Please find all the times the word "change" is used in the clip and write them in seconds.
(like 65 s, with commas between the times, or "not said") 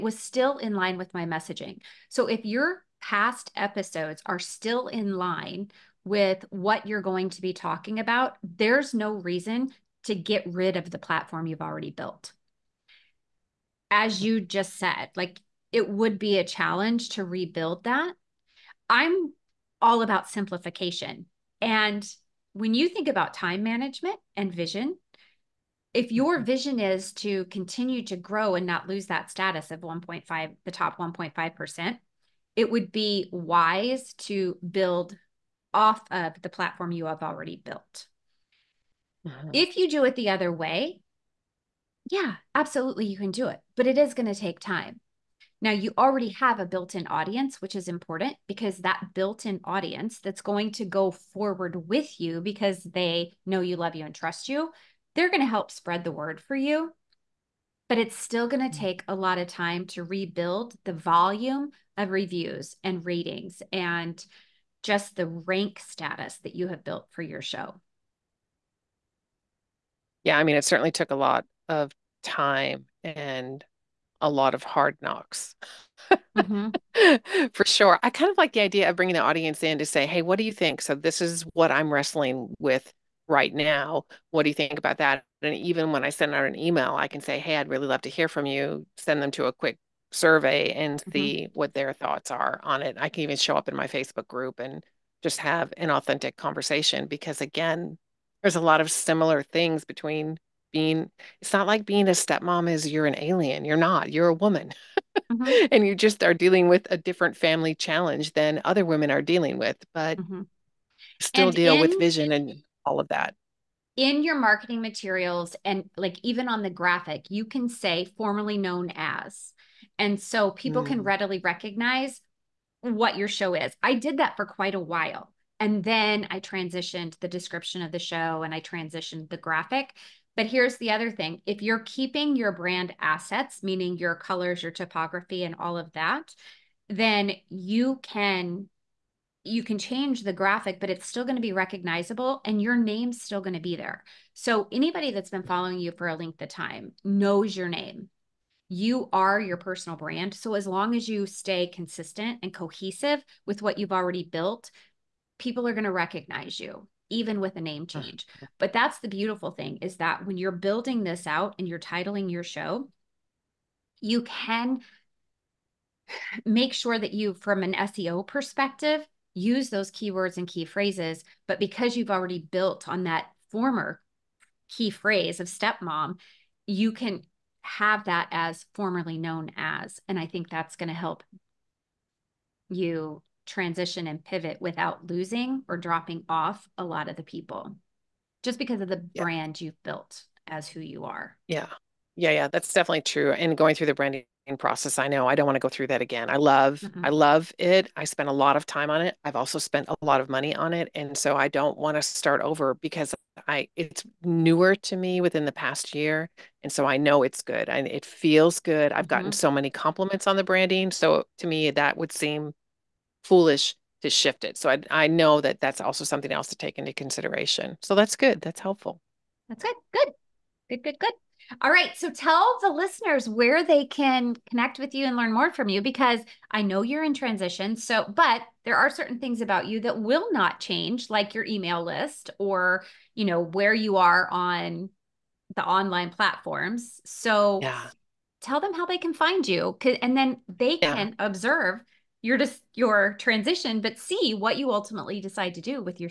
139 s, 157 s, 230 s.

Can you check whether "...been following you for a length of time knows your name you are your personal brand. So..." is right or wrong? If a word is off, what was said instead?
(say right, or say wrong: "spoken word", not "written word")
right.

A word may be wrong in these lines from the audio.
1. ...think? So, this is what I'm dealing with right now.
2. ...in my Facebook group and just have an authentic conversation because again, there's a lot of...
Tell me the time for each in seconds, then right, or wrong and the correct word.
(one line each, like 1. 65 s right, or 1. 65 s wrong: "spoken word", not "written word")
1. 80 s wrong: "wrestling", not "dealing"
2. 93 s right.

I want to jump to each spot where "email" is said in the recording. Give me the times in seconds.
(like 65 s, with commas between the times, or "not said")
86 s, 231 s.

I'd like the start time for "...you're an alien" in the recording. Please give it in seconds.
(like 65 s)
102 s.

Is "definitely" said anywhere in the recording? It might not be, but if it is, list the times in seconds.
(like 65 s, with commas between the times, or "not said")
192 s.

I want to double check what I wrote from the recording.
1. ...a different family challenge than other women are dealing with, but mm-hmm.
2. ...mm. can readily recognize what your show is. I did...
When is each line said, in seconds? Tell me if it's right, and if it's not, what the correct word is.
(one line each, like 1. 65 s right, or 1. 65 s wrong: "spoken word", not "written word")
1. 106 s right
2. 120 s right.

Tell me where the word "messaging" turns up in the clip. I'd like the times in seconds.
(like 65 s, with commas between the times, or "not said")
1 s.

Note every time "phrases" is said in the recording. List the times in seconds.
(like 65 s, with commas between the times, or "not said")
170 s, 174 s.